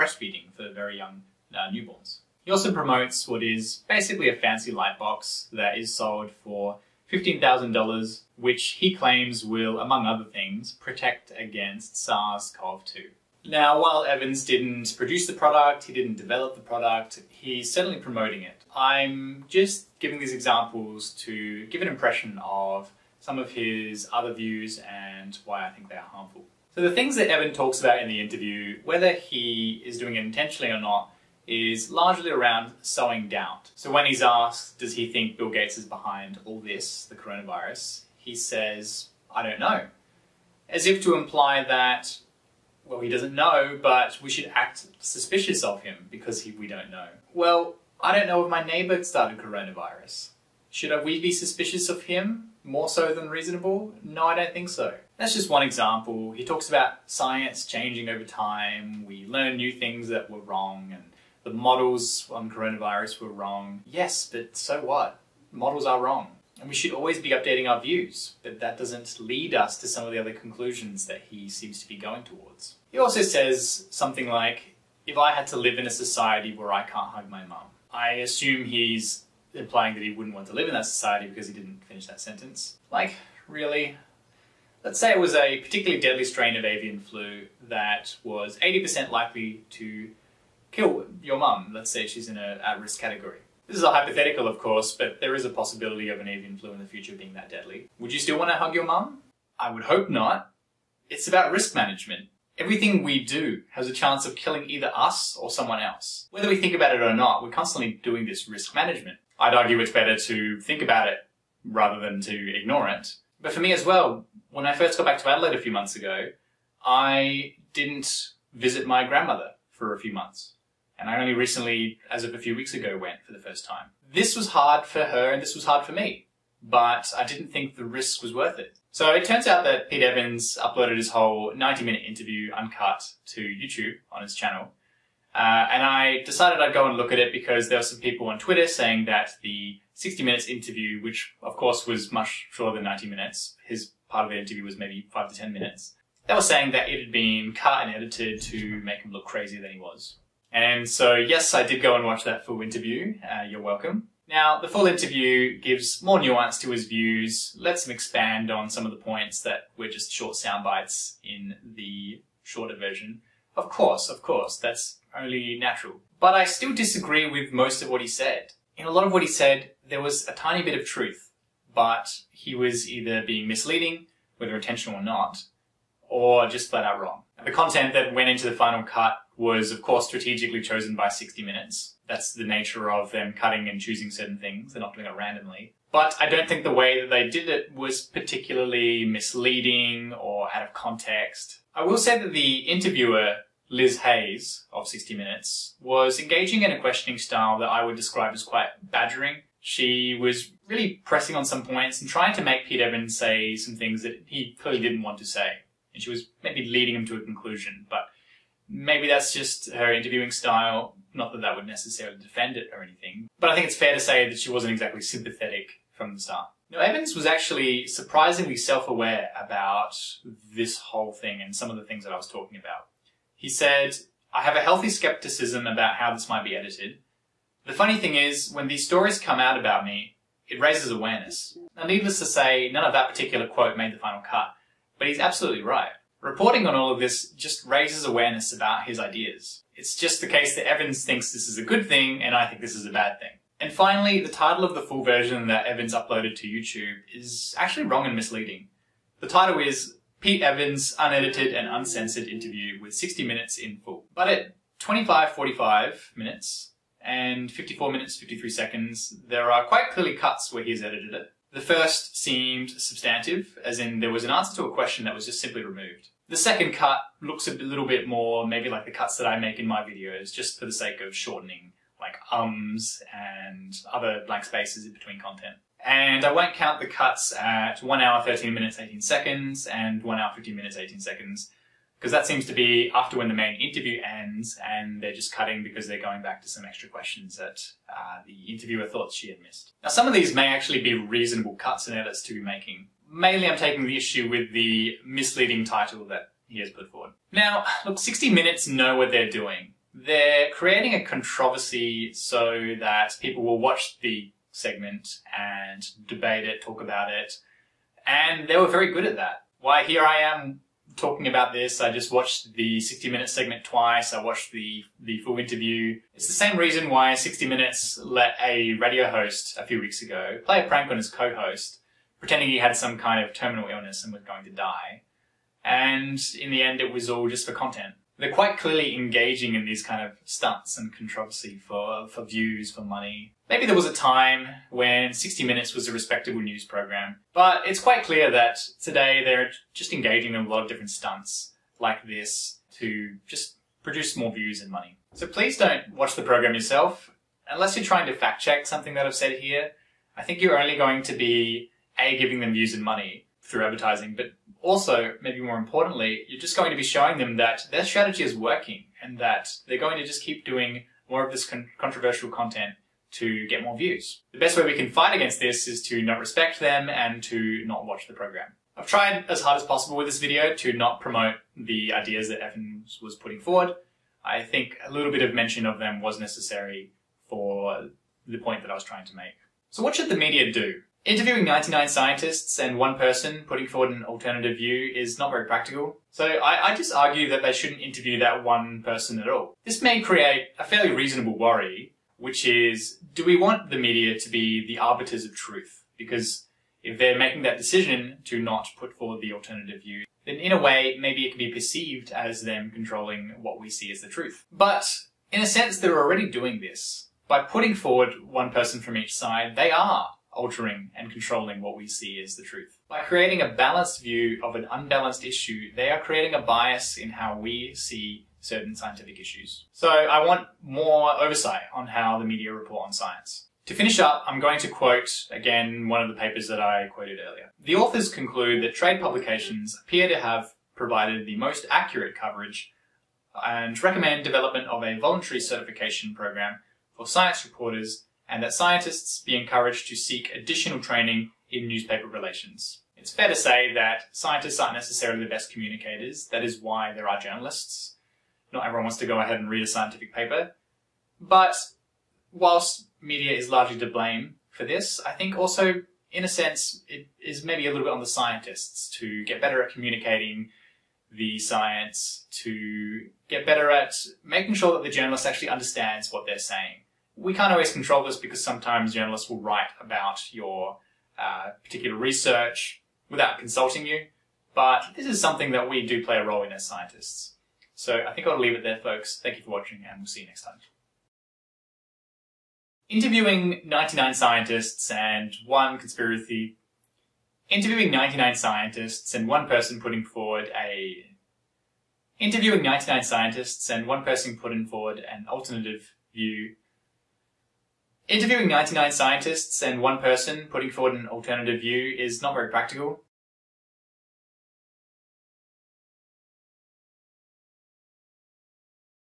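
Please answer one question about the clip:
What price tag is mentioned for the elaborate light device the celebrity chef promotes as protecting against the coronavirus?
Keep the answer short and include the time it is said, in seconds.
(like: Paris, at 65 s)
$15,000, at 7 s.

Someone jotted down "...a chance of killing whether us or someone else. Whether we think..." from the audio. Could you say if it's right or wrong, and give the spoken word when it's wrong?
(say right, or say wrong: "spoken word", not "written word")
wrong: "either", not "whether".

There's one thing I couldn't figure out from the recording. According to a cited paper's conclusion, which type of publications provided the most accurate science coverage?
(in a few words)
trade publications.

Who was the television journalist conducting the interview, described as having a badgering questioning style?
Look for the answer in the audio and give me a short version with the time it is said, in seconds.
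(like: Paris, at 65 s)
Liz Hayes, at 193 s.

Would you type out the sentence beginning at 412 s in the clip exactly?
By creating a balanced view of an unbalanced issue, they are creating a bias in how we see certain scientific issues.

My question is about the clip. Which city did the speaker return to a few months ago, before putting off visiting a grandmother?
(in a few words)
Adelaide.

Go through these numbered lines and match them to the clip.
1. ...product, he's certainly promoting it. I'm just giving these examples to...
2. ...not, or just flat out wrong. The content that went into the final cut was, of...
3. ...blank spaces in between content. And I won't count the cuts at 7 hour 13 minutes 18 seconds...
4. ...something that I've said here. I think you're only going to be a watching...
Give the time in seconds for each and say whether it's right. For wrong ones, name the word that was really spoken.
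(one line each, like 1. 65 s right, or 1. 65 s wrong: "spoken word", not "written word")
1. 16 s right
2. 175 s right
3. 274 s wrong: "1", not "7"
4. 348 s wrong: "giving", not "watching".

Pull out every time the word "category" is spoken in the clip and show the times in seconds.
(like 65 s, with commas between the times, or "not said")
93 s.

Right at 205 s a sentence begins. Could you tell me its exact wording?
And she was maybe leading him to a conclusion, but maybe that's just her interviewing style.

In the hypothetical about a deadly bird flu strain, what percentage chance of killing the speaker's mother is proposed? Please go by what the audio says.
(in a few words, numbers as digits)
80%.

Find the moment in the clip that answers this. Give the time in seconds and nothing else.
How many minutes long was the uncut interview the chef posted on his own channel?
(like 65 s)
131 s.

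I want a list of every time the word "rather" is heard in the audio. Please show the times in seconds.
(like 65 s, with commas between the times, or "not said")
111 s.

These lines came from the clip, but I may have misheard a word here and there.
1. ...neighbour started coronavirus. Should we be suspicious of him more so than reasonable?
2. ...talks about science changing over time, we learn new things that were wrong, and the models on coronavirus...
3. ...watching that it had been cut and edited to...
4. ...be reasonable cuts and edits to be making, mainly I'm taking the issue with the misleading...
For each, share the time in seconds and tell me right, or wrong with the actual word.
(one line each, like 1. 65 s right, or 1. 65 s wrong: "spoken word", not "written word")
1. 48 s right
2. 56 s right
3. 146 s wrong: "saying", not "watching"
4. 290 s right.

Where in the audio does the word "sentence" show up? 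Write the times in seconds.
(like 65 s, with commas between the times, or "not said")
82 s.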